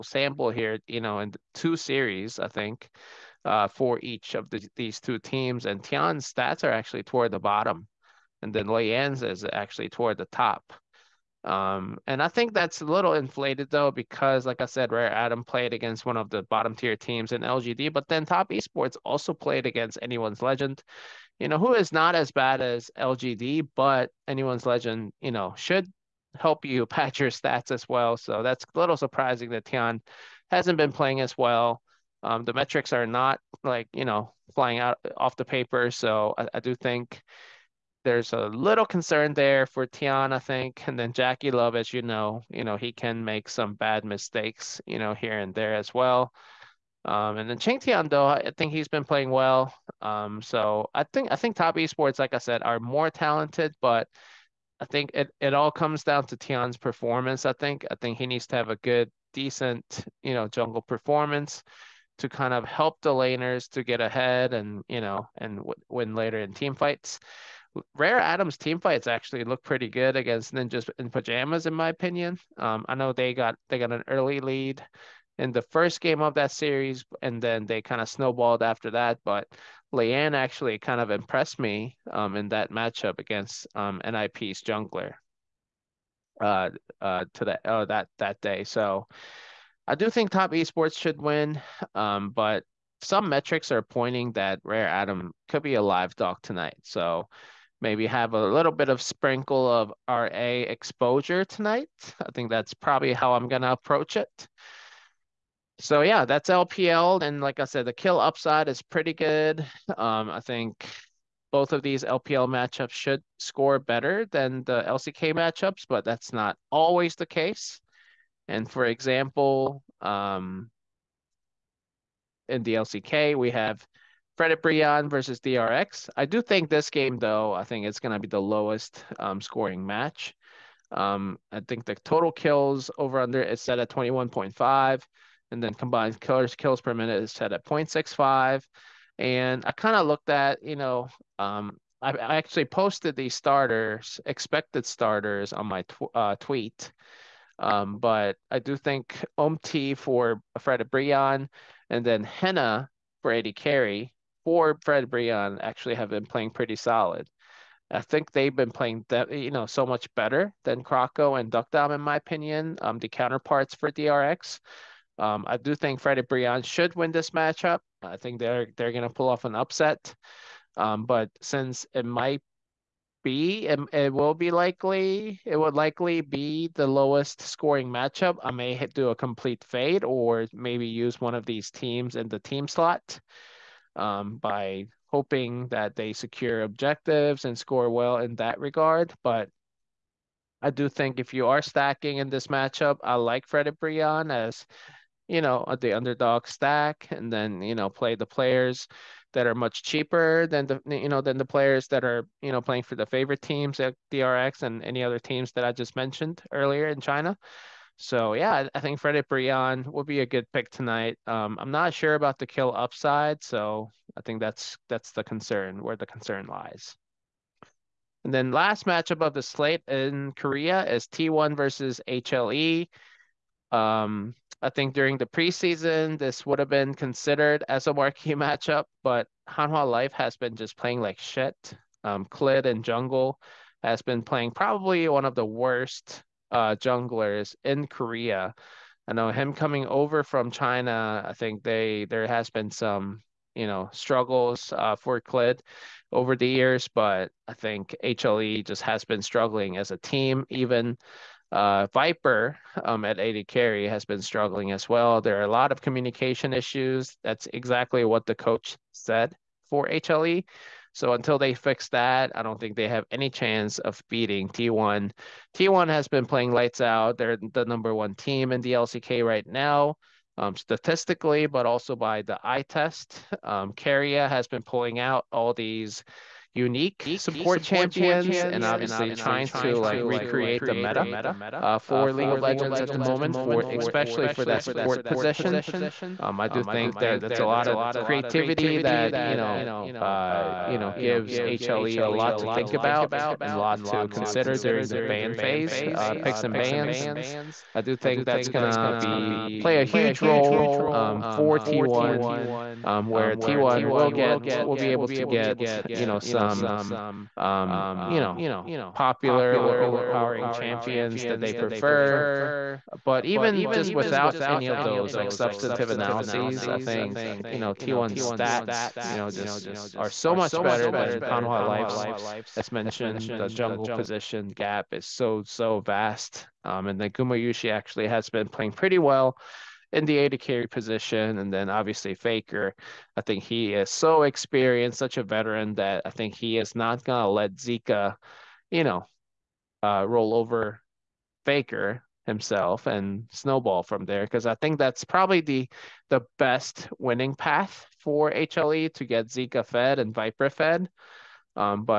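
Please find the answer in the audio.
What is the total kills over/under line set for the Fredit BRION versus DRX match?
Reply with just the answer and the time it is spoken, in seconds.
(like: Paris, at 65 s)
21.5, at 133 s.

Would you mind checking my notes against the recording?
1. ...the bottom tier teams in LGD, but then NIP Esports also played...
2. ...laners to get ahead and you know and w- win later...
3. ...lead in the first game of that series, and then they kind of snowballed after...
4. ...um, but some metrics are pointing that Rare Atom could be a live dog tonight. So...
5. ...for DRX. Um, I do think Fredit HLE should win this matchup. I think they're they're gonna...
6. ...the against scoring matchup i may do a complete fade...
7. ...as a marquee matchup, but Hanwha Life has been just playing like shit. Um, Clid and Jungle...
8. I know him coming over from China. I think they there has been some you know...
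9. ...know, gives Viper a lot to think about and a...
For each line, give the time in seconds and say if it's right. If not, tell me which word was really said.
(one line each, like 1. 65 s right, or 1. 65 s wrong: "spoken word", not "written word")
1. 16 s wrong: "Top", not "NIP"
2. 63 s right
3. 74 s right
4. 91 s right
5. 163 s wrong: "BRION", not "HLE"
6. 176 s wrong: "lowest", not "against"
7. 227 s right
8. 239 s right
9. 290 s wrong: "HLE", not "Viper".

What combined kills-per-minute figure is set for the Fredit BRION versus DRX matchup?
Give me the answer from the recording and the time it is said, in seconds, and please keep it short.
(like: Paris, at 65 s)
0.65, at 137 s.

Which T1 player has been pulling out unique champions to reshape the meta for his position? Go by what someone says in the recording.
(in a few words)
Keria.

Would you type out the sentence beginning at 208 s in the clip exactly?
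So yeah, I think Fredit BRION would be a good pick tonight.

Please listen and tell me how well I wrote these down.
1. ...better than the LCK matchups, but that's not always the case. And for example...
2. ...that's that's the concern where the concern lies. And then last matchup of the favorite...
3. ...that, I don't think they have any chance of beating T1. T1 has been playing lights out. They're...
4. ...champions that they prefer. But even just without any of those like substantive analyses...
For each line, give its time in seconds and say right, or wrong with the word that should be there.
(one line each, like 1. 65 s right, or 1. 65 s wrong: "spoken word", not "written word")
1. 113 s right
2. 214 s wrong: "slate", not "favorite"
3. 261 s right
4. 310 s right.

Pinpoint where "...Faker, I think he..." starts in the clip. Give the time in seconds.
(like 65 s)
332 s.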